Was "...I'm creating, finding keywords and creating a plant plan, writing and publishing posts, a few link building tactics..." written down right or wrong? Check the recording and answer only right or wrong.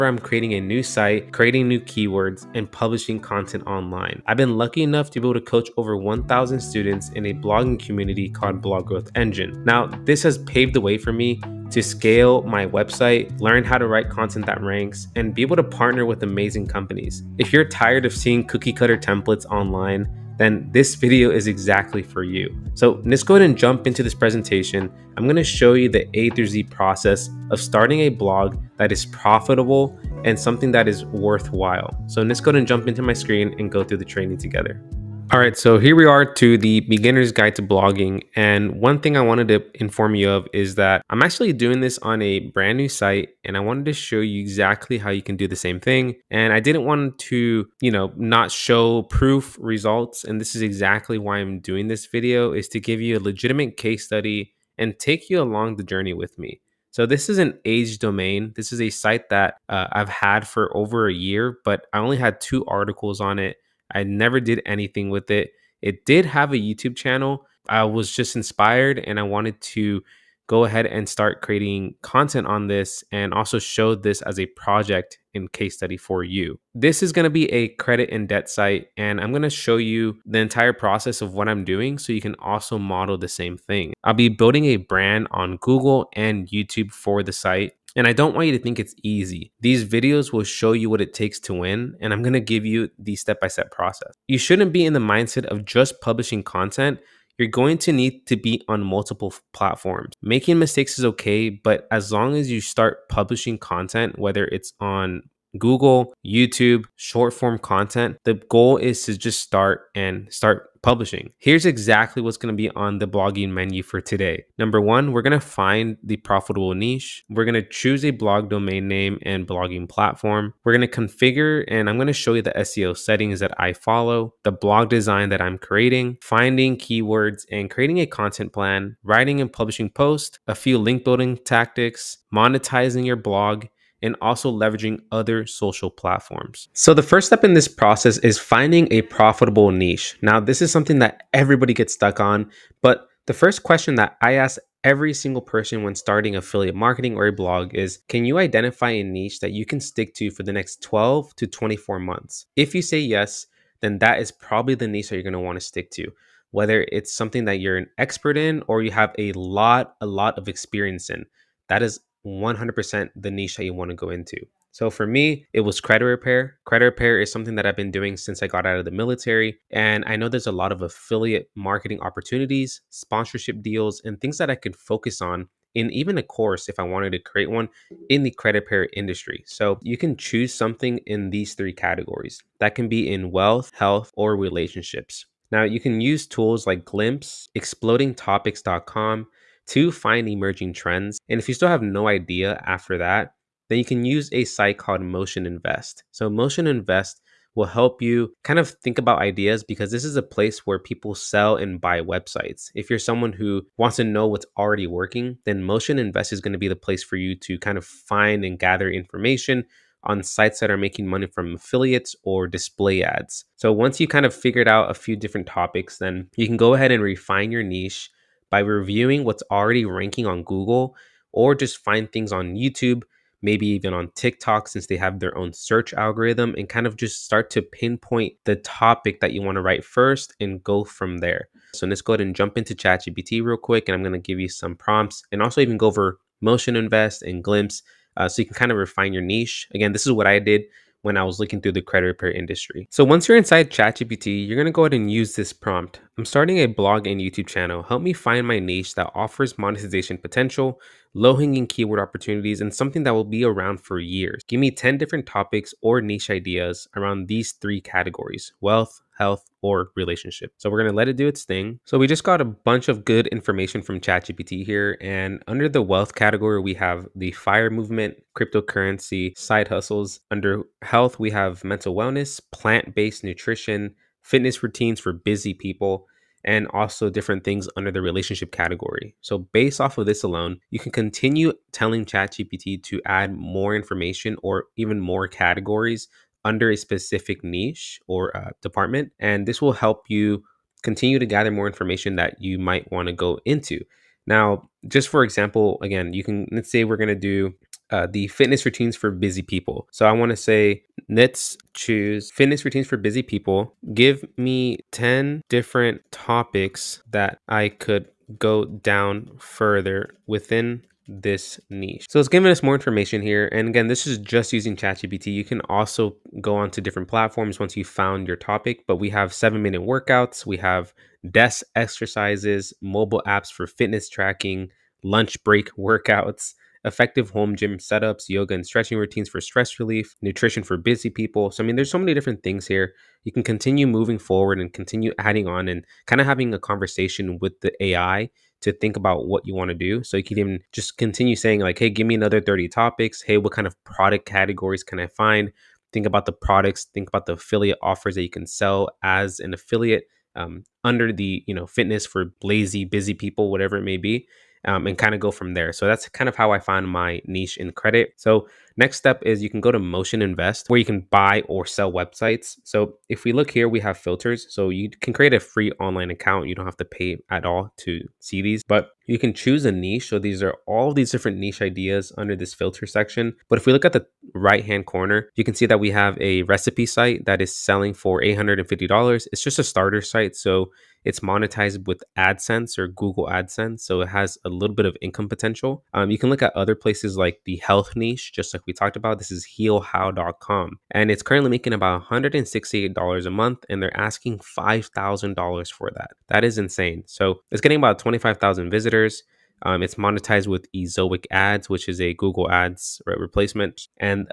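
wrong.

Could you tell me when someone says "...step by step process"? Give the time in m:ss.
1:33.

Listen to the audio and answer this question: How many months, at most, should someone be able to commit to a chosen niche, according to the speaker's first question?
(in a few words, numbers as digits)
24.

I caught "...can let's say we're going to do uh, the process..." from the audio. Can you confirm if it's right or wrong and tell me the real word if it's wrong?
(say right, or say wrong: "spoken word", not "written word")
wrong: "fitness", not "process".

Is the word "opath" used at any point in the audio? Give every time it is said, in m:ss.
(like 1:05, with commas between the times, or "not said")
not said.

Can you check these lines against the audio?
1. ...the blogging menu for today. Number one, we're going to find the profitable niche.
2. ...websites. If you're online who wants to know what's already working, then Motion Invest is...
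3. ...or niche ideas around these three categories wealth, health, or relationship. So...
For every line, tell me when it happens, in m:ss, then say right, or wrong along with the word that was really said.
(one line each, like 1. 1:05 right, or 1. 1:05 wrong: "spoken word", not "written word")
1. 1:52 right
2. 3:22 wrong: "someone", not "online"
3. 4:15 right.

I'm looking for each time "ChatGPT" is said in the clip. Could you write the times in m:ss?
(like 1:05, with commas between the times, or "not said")
3:52, 4:03, 4:23, 4:42, 5:14.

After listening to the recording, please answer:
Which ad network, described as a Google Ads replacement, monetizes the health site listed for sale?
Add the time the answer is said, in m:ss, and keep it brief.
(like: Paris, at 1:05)
Ezoic, at 6:40.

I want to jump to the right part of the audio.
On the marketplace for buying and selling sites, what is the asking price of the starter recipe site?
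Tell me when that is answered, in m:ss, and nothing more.
6:18.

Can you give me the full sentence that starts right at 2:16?
So, the first step in this process is finding a profitable niche.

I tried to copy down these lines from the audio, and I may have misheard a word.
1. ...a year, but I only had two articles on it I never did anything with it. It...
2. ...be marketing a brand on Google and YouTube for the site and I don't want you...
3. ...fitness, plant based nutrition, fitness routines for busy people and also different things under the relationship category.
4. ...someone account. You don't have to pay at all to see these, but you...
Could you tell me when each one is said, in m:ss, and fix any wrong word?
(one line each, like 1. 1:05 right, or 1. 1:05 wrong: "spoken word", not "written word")
1. 1:01 right
2. 1:24 wrong: "building", not "marketing"
3. 4:31 wrong: "wellness", not "fitness"
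4. 6:05 wrong: "online", not "someone".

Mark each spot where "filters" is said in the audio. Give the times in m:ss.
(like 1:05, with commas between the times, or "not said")
6:03, 6:12.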